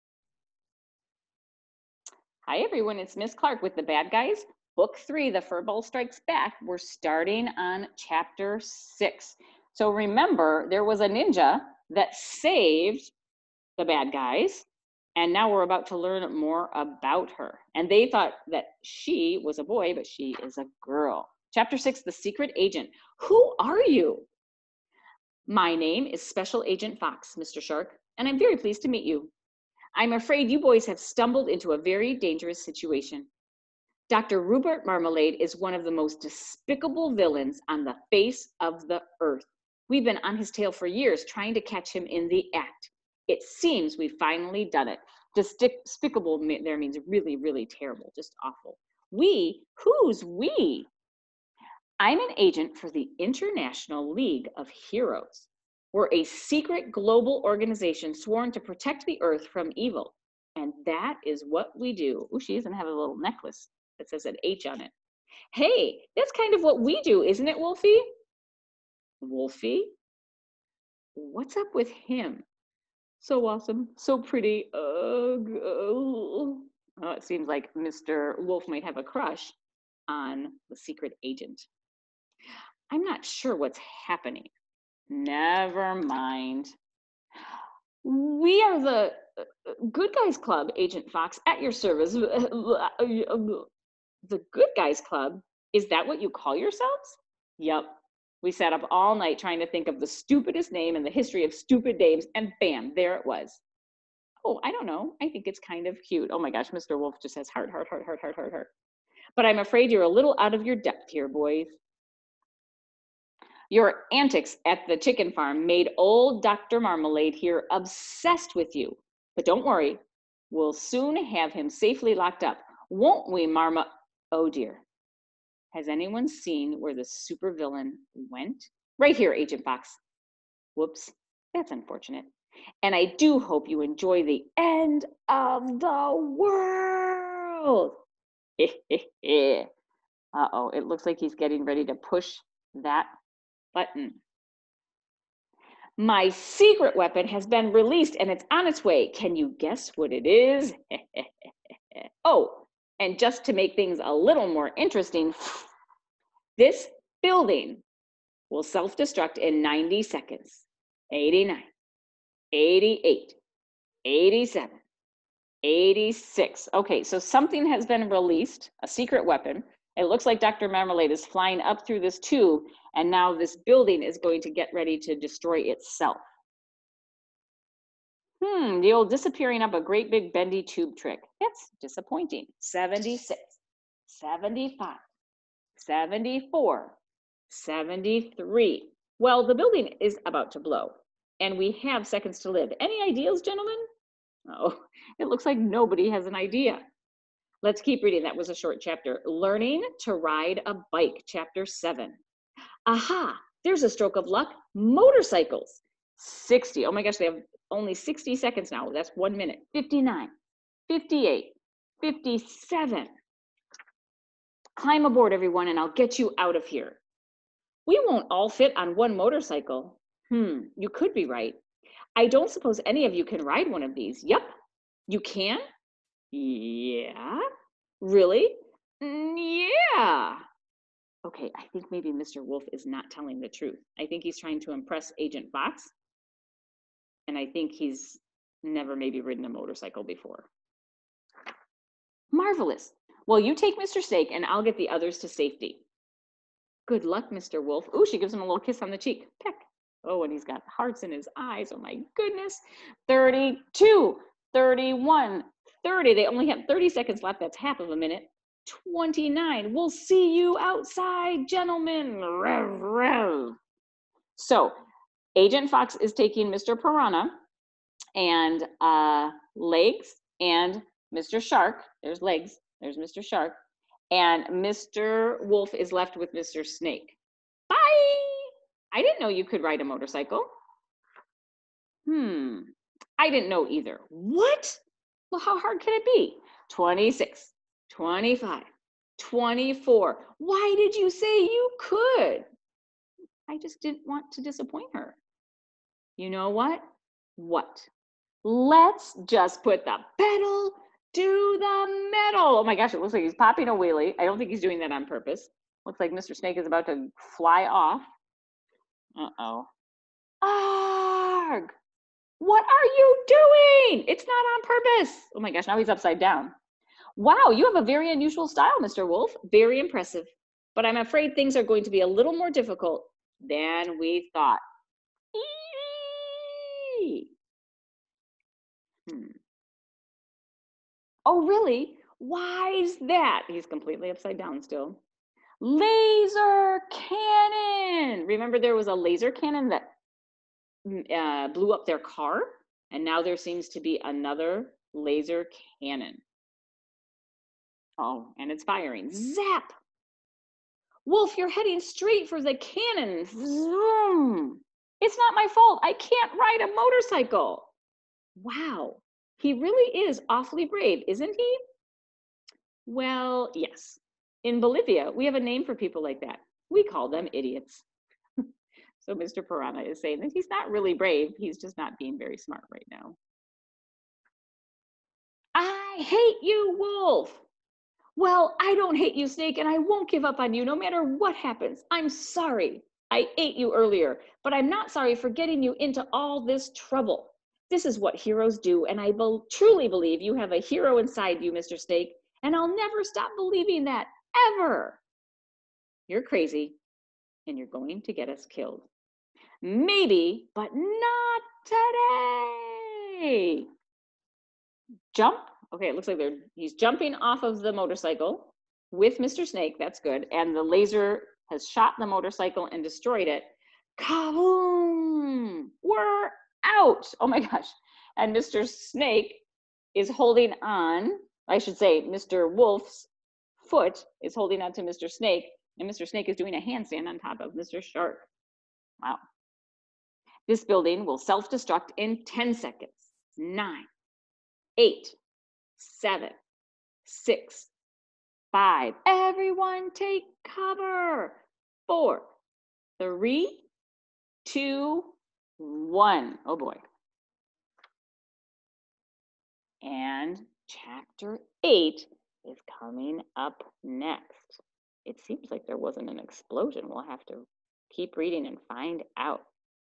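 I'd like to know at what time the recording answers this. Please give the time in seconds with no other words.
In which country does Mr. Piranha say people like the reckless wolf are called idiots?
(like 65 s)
364 s.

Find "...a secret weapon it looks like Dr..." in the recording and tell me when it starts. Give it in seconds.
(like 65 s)
168 s.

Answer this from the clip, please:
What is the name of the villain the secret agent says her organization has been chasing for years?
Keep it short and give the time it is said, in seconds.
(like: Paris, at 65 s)
Dr. Rupert Marmalade, at 34 s.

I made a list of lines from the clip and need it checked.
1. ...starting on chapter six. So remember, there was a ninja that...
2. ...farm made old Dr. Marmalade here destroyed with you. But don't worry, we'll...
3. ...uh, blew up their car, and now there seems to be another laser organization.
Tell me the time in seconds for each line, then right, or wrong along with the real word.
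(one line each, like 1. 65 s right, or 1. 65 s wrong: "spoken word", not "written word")
1. 6 s right
2. 115 s wrong: "obsessed", not "destroyed"
3. 340 s wrong: "cannon", not "organization".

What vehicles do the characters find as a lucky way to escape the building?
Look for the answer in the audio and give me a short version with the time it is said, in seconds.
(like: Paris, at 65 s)
Motorcycles, at 204 s.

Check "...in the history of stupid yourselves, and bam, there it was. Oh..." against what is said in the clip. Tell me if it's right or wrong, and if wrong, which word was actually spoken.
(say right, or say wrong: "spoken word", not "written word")
wrong: "names", not "yourselves".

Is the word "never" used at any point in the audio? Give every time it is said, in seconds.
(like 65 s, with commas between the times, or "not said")
85 s, 238 s, 392 s.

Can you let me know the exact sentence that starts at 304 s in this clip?
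I don't think he's doing that on purpose.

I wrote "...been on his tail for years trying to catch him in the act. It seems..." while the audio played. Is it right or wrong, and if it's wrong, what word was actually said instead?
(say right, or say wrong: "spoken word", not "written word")
right.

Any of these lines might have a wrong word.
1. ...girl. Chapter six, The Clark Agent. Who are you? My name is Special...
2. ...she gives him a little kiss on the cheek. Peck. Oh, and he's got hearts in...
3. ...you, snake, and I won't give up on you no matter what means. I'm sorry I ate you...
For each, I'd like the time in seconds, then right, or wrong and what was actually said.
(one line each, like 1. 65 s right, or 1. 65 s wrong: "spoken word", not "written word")
1. 20 s wrong: "Secret", not "Clark"
2. 248 s right
3. 379 s wrong: "happens", not "means".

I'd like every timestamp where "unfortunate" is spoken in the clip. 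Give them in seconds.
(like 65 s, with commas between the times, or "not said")
131 s.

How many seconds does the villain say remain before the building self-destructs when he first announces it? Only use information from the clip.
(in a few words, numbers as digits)
90.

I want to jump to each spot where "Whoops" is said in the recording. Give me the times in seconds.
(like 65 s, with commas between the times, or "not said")
130 s.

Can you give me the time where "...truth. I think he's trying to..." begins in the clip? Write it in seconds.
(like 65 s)
233 s.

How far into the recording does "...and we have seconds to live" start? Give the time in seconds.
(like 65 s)
191 s.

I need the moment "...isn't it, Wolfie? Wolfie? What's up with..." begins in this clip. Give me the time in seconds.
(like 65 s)
67 s.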